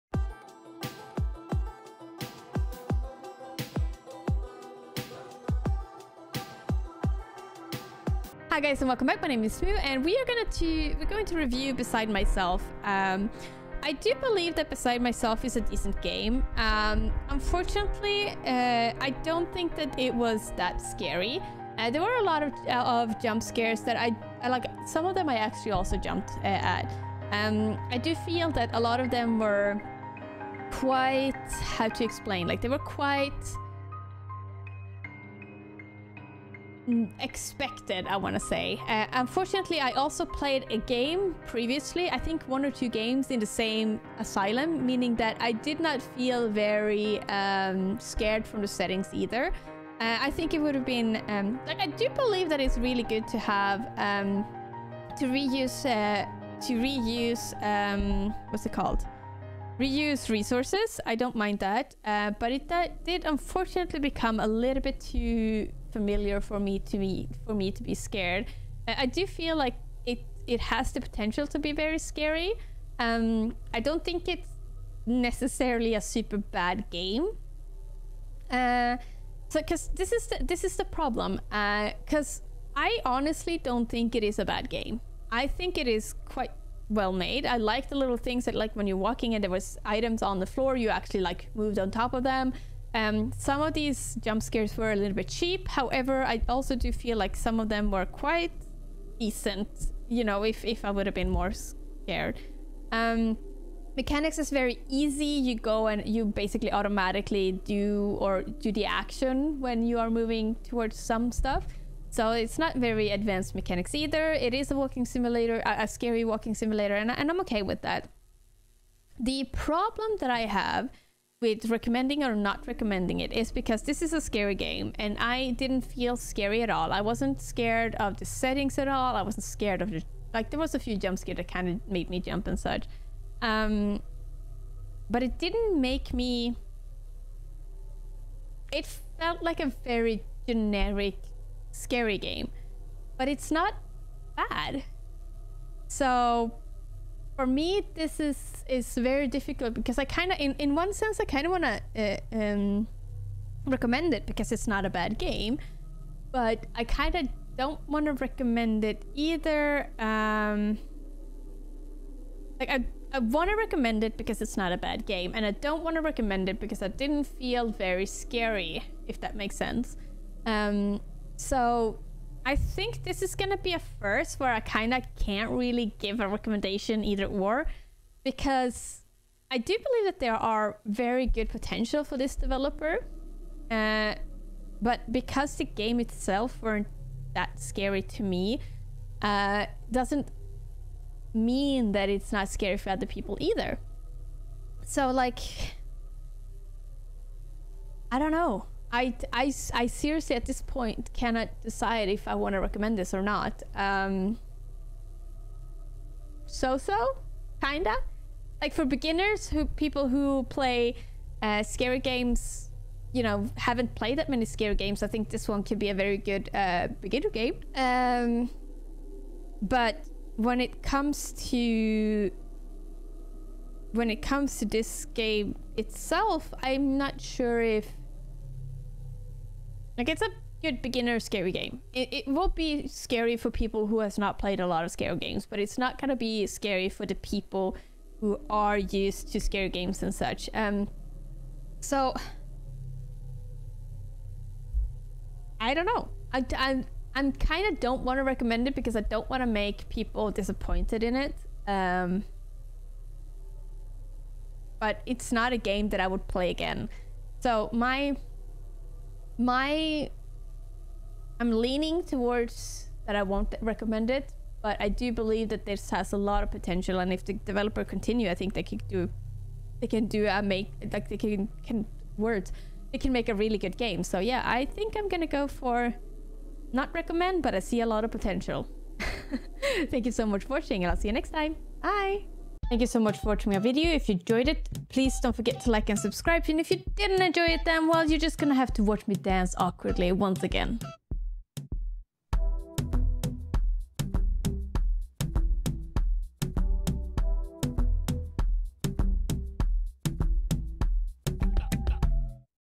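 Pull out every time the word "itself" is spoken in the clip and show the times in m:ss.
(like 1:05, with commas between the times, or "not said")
3:05, 3:45.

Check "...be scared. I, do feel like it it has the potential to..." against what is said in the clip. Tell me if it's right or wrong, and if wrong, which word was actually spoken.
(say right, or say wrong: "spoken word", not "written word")
right.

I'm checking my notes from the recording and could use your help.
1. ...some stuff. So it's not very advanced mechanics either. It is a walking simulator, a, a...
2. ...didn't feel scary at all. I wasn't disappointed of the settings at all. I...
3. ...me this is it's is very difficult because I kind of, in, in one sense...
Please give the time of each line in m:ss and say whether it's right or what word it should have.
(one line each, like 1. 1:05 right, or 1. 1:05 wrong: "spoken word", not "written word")
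1. 1:50 right
2. 2:05 wrong: "scared", not "disappointed"
3. 2:27 right.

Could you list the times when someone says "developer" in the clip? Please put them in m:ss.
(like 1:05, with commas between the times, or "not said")
3:02, 4:27.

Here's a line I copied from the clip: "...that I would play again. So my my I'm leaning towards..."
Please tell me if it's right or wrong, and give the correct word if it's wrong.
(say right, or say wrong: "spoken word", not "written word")
right.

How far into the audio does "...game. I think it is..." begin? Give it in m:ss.
1:24.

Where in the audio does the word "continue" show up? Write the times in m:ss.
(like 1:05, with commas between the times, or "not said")
4:27.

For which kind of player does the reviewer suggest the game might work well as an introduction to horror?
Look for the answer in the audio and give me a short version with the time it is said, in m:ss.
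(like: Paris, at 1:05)
beginners, at 3:28.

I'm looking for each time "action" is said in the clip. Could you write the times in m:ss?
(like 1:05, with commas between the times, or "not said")
1:48.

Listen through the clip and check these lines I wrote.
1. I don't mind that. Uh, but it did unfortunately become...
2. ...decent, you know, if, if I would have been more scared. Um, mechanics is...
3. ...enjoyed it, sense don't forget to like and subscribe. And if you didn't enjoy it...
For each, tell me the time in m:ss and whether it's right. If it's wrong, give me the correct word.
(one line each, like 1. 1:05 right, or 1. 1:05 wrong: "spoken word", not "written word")
1. 1:01 right
2. 1:39 right
3. 4:44 wrong: "please", not "sense".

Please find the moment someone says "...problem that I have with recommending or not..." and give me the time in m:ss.
1:59.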